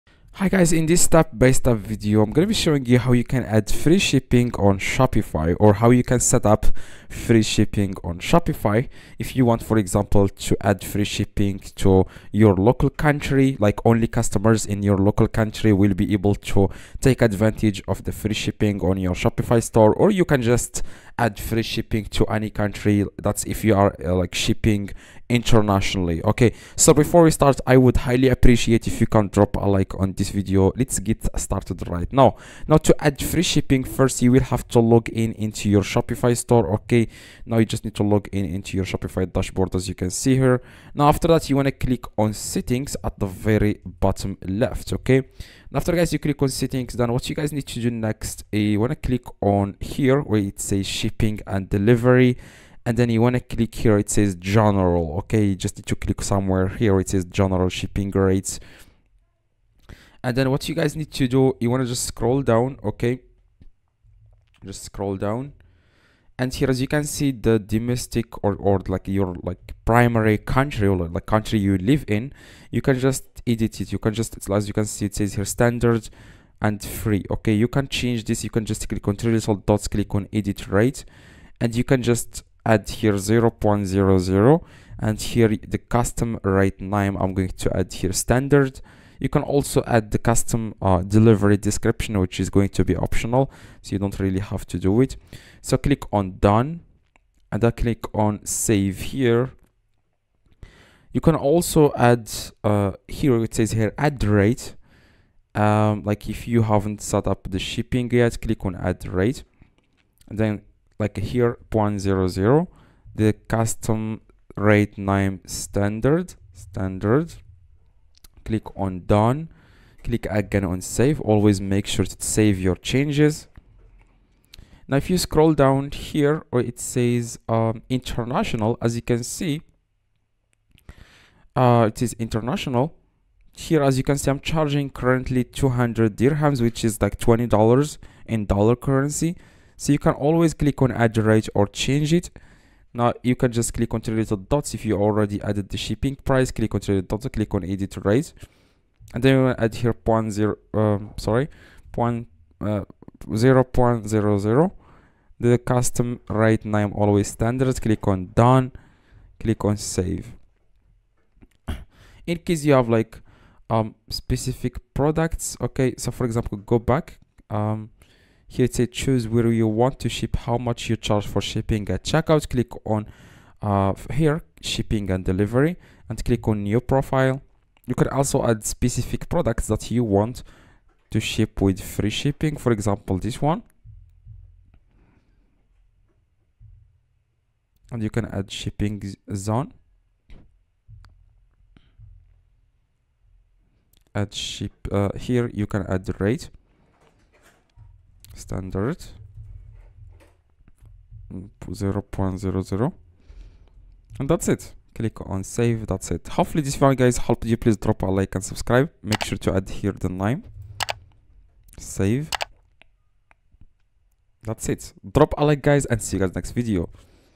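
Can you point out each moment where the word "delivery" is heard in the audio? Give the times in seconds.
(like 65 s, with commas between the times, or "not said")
51 s, 91 s, 175 s.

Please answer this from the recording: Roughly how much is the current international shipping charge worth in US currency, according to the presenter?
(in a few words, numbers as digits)
20 dollars.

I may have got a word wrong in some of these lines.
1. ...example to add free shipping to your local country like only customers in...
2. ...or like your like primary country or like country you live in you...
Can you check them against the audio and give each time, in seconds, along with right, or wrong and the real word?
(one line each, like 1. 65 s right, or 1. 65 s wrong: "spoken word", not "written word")
1. 9 s right
2. 68 s right.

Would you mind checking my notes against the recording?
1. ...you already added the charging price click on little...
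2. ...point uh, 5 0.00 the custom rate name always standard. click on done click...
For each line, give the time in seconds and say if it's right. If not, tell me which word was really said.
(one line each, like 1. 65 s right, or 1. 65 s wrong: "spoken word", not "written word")
1. 144 s wrong: "shipping", not "charging"
2. 151 s wrong: "0", not "5".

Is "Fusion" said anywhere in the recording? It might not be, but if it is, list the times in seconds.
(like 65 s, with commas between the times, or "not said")
not said.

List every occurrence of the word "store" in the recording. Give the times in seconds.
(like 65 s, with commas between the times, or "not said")
19 s, 36 s.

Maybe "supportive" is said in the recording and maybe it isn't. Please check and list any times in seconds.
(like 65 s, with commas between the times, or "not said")
not said.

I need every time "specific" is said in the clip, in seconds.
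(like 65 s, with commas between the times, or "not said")
164 s, 178 s.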